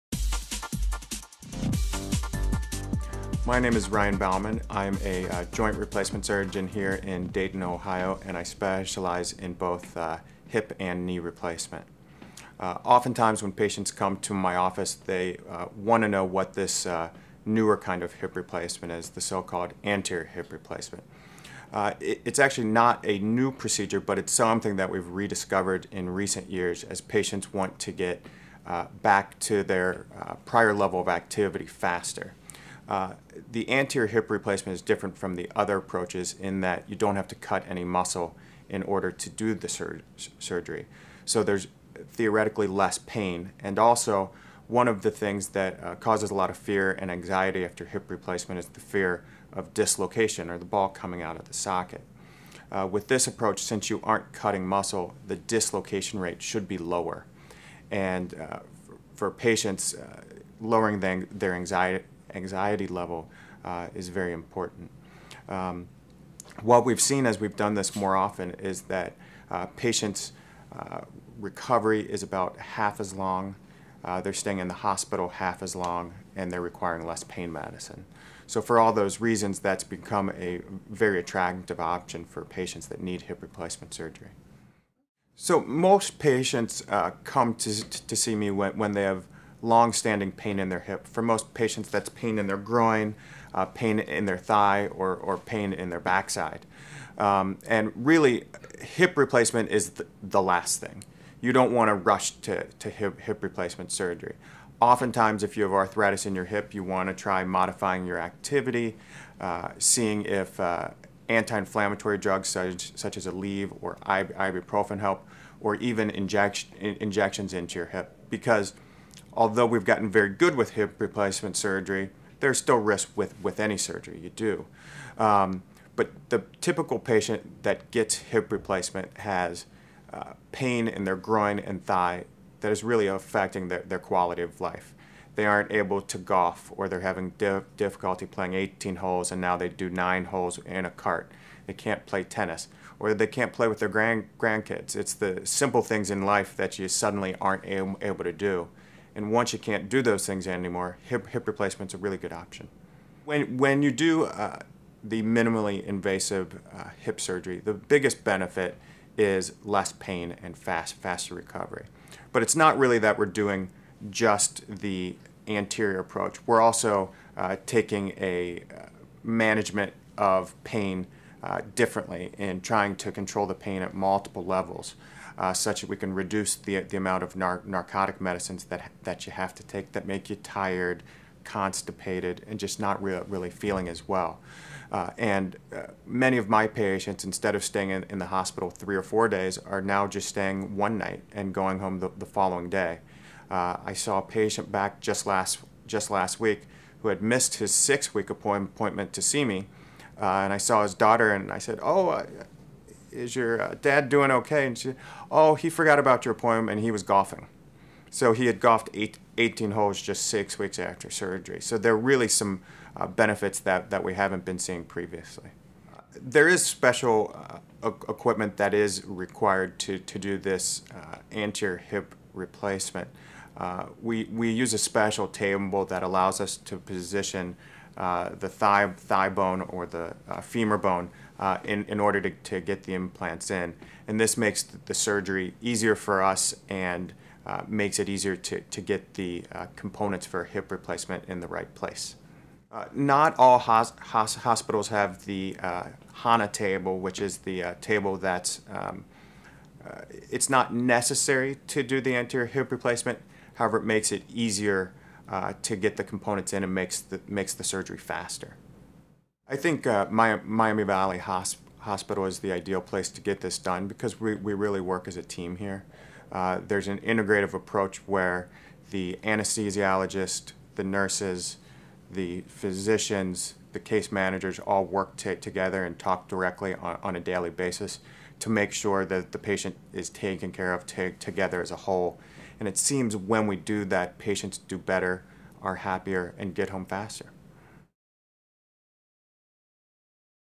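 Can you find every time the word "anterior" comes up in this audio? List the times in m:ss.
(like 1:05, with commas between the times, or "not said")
0:19, 0:33, 2:45, 3:41, 4:12.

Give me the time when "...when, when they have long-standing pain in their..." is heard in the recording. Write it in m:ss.
1:28.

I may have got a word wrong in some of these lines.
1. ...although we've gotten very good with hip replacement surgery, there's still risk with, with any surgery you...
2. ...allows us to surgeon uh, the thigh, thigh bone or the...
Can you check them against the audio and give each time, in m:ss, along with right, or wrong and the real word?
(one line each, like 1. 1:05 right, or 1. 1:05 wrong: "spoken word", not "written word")
1. 1:59 right
2. 3:46 wrong: "position", not "surgeon".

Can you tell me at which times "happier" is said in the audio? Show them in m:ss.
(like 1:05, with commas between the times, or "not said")
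4:45.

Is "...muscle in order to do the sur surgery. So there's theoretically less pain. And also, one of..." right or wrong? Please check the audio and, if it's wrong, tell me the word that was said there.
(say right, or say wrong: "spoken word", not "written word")
right.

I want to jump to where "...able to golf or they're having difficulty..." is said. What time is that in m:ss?
2:15.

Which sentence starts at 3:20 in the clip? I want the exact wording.
Uh, and I saw his daughter, and I said, "Oh, uh, is your uh, dad doing okay?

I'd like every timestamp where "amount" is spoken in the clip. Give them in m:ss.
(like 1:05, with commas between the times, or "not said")
2:56.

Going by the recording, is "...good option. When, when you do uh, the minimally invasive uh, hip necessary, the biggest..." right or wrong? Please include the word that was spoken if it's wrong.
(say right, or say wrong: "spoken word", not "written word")
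wrong: "surgery", not "necessary".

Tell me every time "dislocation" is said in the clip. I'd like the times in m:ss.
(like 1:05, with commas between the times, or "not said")
0:49, 0:55.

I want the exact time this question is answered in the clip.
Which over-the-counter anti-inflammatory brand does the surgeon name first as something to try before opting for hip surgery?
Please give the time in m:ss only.
1:53.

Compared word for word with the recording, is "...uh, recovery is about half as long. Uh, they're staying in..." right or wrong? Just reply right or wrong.
right.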